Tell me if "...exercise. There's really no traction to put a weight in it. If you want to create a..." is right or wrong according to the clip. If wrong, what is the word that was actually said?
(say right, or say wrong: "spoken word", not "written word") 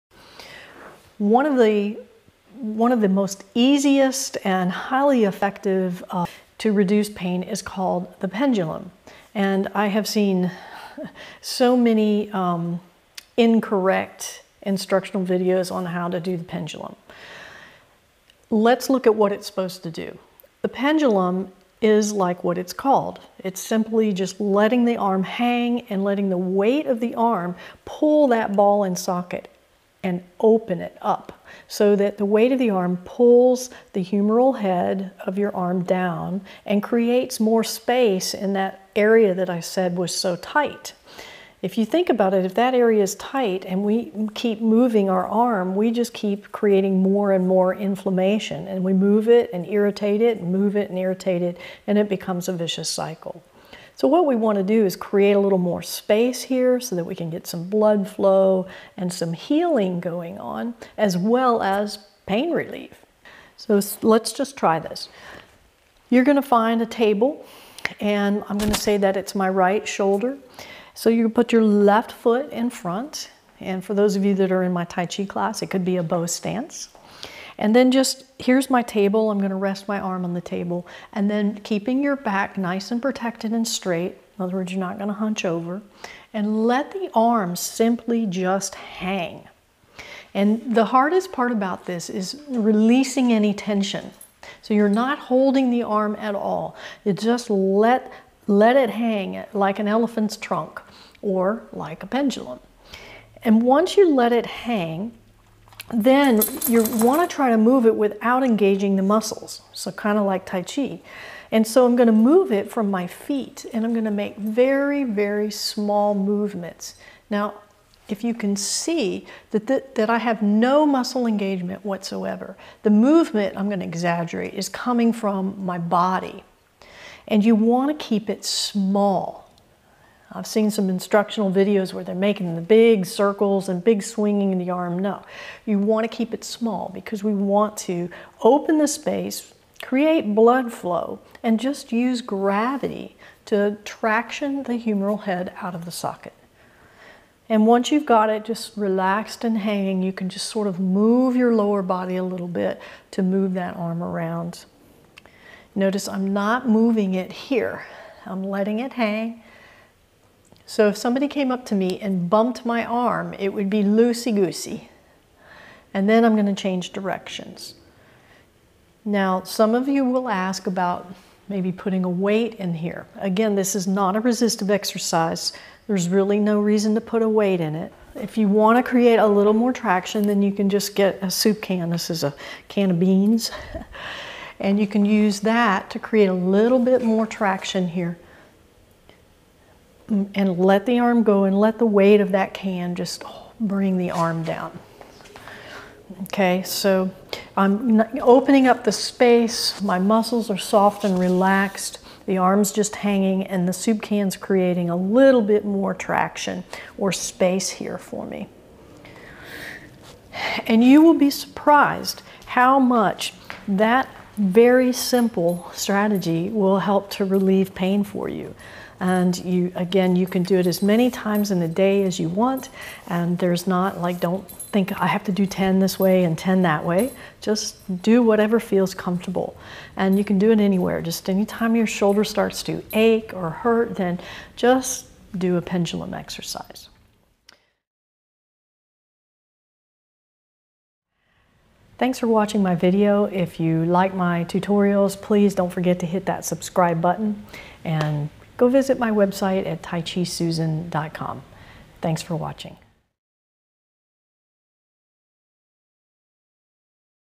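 wrong: "reason", not "traction".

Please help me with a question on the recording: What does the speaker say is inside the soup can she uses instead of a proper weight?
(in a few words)
beans.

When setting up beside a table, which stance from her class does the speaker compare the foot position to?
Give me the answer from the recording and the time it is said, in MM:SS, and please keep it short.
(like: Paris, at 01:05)
bow stance, at 01:16.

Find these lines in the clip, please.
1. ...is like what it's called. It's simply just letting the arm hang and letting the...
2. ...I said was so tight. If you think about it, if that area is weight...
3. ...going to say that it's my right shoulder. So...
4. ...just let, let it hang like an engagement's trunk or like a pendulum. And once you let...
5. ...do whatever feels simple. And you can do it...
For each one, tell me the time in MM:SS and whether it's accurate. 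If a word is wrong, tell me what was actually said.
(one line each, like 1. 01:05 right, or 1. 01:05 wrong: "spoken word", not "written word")
1. 00:21 right
2. 00:39 wrong: "tight", not "weight"
3. 01:08 right
4. 01:37 wrong: "elephant", not "engagement"
5. 03:48 wrong: "comfortable", not "simple".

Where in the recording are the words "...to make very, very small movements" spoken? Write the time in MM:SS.
01:54.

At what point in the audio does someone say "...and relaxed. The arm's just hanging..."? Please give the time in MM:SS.
03:21.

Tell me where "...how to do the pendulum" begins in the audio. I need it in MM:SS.
00:15.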